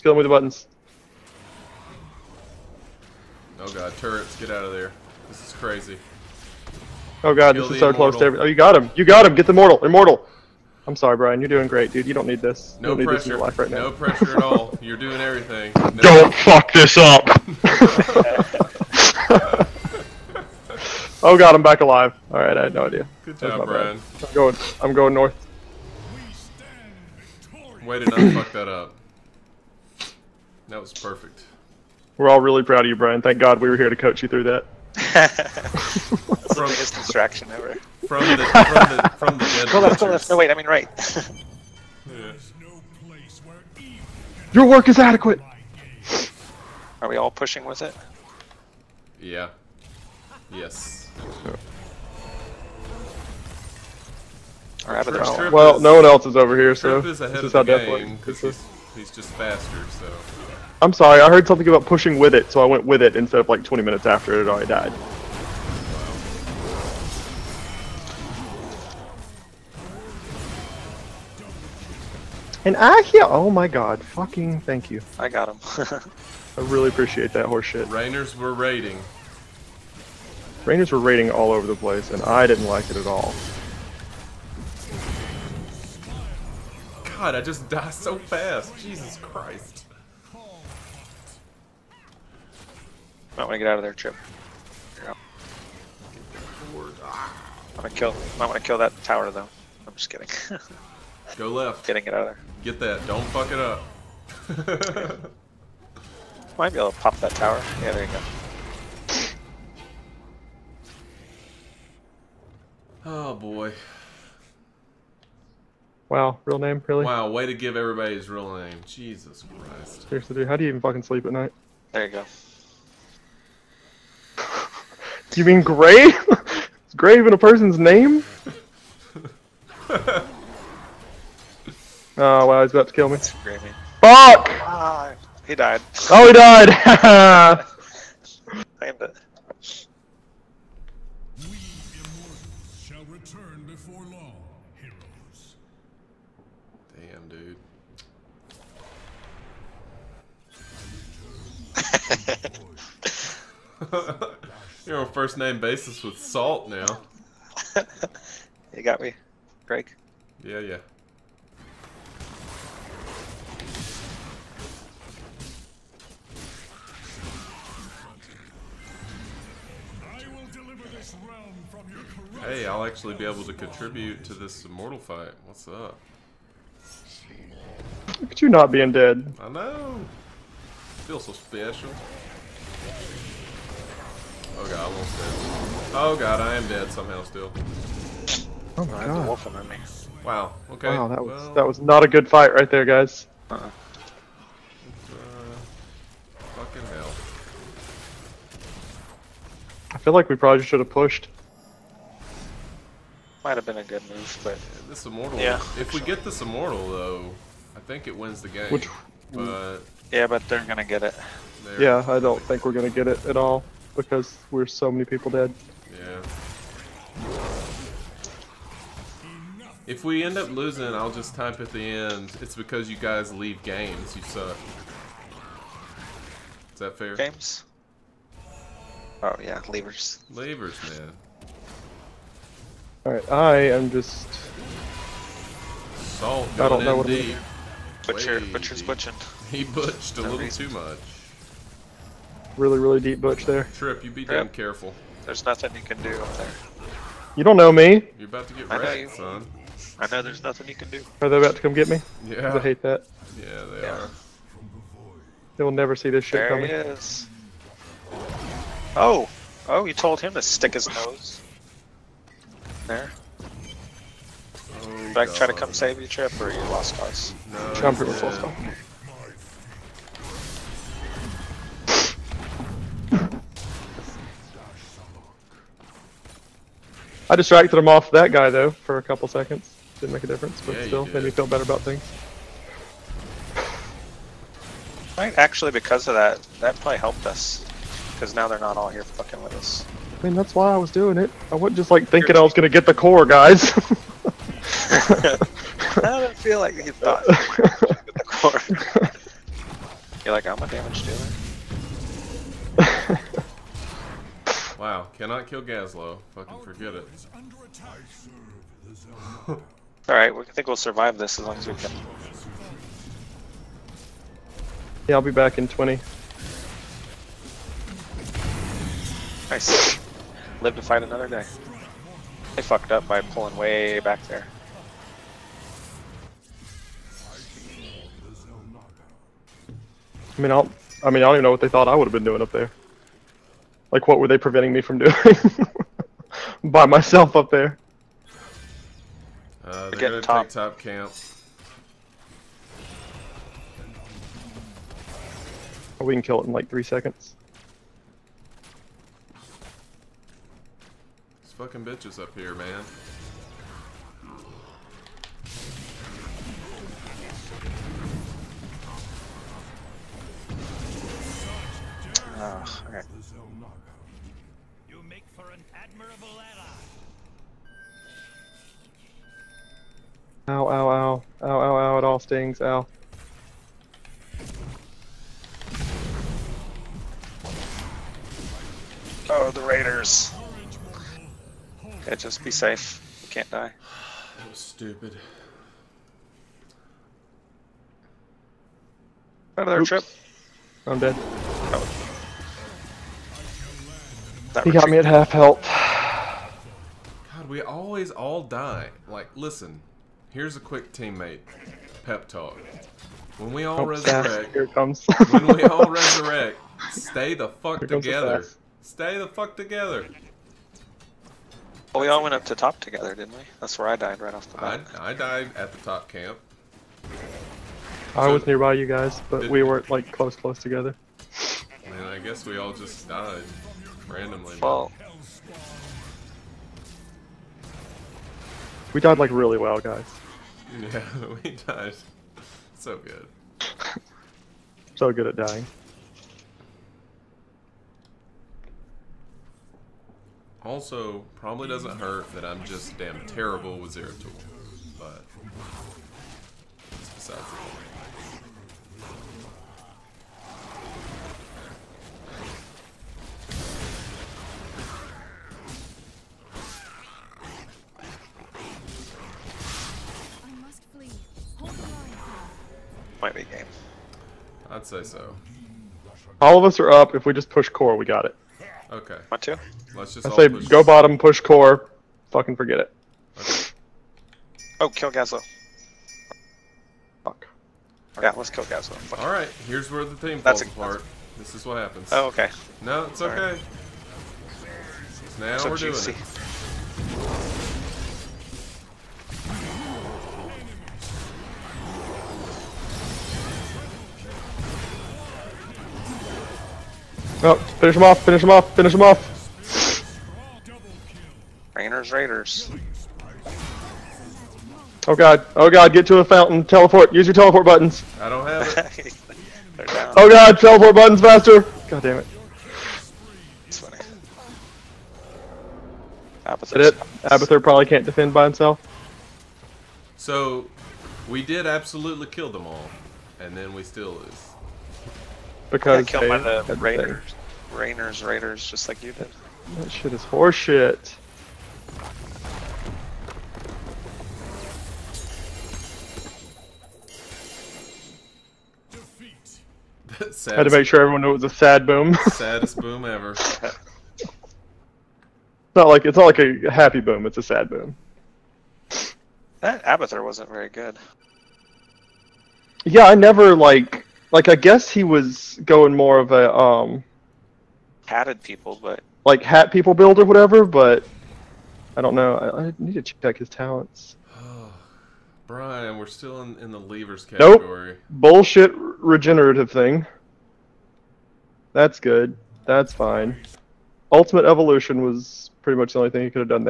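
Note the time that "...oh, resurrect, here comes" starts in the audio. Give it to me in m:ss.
6:43.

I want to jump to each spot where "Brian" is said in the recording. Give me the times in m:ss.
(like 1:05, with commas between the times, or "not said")
0:11, 0:23, 0:32, 9:25.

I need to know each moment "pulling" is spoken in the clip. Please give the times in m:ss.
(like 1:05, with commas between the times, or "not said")
5:23.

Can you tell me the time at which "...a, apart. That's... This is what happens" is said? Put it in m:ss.
8:00.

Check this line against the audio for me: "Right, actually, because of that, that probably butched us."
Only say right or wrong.
wrong.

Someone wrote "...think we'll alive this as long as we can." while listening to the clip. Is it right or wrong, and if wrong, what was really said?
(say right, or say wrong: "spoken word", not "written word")
wrong: "survive", not "alive".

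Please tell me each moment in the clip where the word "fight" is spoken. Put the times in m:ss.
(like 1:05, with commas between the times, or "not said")
2:54, 3:12, 5:20.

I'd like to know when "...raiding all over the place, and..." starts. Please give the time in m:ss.
1:20.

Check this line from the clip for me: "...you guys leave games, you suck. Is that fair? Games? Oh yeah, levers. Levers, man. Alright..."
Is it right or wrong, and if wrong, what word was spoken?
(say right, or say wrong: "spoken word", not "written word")
right.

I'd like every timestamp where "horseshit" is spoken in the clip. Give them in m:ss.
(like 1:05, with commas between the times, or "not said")
1:17, 8:50.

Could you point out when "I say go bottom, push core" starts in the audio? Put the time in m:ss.
7:50.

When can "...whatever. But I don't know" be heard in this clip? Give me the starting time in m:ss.
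9:20.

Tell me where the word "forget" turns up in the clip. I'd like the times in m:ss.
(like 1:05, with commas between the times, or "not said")
5:06, 7:52.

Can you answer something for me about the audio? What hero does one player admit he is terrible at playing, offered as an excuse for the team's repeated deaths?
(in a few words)
Zeratul.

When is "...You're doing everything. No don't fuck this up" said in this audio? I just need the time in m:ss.
0:14.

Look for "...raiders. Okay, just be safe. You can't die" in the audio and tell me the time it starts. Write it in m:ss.
6:19.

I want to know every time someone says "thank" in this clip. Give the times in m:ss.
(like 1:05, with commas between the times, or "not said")
0:33, 1:14.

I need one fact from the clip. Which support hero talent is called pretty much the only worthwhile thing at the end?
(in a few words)
Ultimate Evolution.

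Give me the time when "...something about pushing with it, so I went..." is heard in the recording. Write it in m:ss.
1:01.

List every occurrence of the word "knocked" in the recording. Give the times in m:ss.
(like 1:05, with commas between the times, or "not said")
not said.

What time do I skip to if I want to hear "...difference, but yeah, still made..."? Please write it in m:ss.
4:40.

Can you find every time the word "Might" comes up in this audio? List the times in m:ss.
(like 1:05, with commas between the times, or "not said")
1:33, 1:38, 1:46, 3:23.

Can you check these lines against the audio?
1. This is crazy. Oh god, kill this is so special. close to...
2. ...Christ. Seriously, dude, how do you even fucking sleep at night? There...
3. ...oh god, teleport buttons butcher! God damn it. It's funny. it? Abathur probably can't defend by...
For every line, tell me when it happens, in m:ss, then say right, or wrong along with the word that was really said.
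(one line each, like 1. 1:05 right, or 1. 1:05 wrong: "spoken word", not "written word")
1. 0:05 wrong: "immortal", not "special"
2. 1:59 right
3. 8:30 wrong: "faster", not "butcher".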